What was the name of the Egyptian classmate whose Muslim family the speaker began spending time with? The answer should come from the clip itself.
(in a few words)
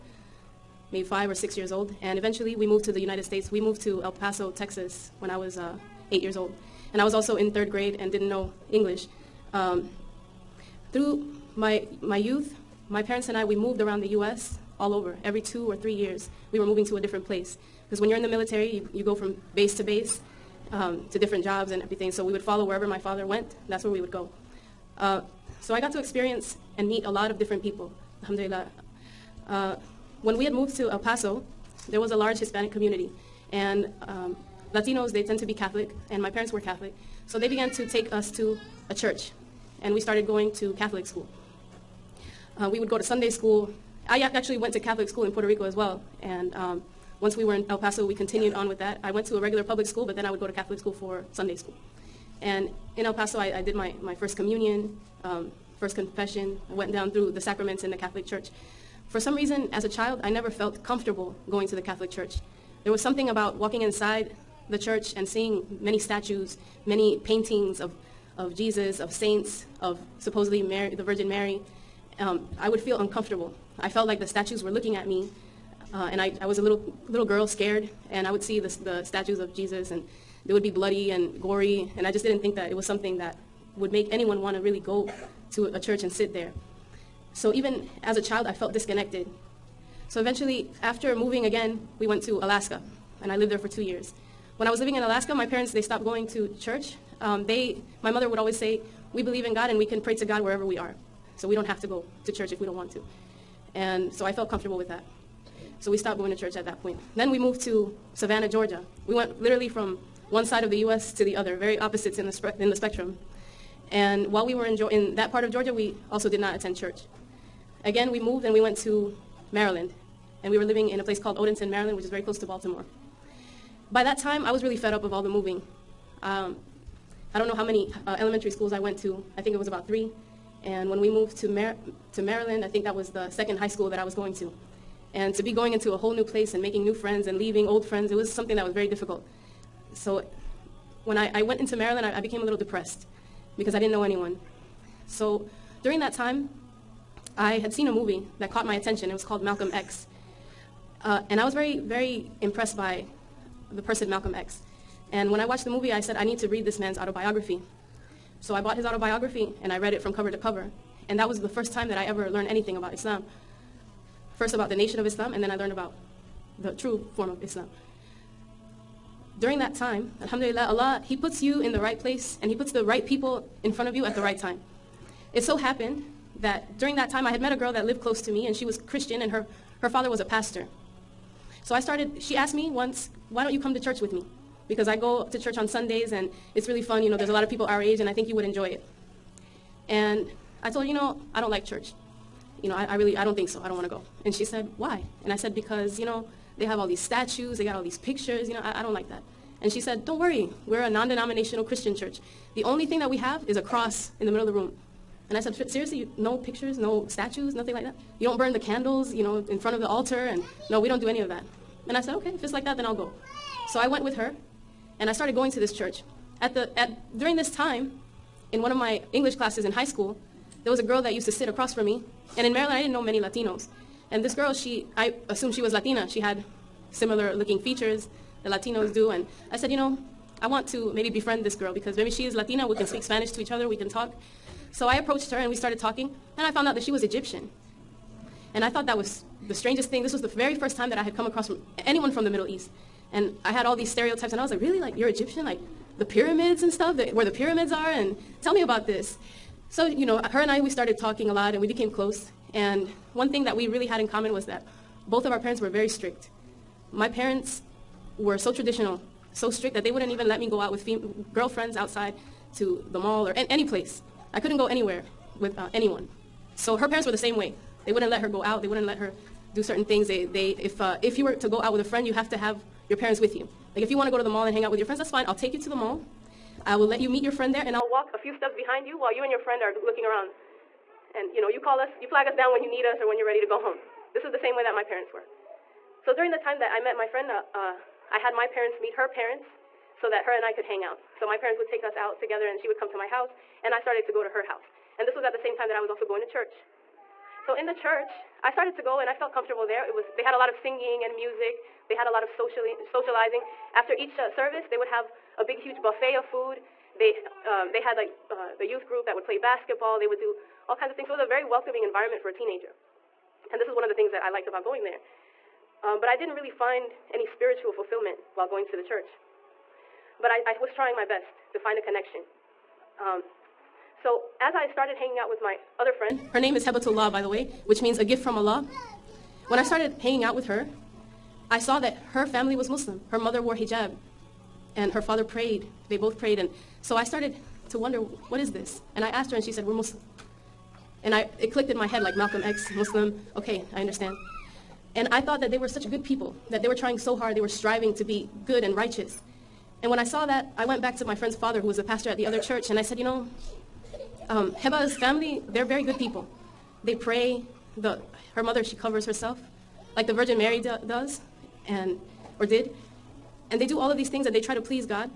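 Hebatullah.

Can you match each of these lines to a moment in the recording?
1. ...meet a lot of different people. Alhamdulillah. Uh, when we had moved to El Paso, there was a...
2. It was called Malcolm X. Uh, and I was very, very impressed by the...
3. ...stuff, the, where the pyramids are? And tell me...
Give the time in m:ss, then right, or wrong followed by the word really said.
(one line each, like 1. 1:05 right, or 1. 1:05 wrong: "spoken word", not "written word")
1. 0:26 right
2. 2:29 right
3. 4:06 right.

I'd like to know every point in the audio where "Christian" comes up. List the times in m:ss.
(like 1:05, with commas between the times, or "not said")
2:58, 3:21.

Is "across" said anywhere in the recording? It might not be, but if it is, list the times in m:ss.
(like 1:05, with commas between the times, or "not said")
3:41, 4:01.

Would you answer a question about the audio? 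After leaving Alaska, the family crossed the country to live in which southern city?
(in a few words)
Savannah, Georgia.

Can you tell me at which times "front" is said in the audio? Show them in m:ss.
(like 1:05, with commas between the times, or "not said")
2:53, 3:29.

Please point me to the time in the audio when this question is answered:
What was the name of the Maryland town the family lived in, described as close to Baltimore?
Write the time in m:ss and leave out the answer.
2:01.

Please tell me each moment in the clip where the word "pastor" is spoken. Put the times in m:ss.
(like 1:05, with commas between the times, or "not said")
3:00, 5:51.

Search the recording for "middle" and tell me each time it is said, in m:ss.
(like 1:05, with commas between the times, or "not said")
3:24, 4:02.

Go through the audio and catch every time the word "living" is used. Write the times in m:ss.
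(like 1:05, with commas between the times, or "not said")
1:34, 2:00.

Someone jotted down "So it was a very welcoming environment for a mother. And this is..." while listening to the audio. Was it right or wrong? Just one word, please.
wrong.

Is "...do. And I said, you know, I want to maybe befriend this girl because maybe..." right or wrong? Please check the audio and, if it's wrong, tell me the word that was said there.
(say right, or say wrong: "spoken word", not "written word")
right.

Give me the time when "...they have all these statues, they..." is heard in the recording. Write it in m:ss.
3:16.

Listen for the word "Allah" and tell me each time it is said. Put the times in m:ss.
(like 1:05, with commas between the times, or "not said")
2:50, 5:28.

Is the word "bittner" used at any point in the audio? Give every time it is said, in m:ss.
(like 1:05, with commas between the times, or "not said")
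not said.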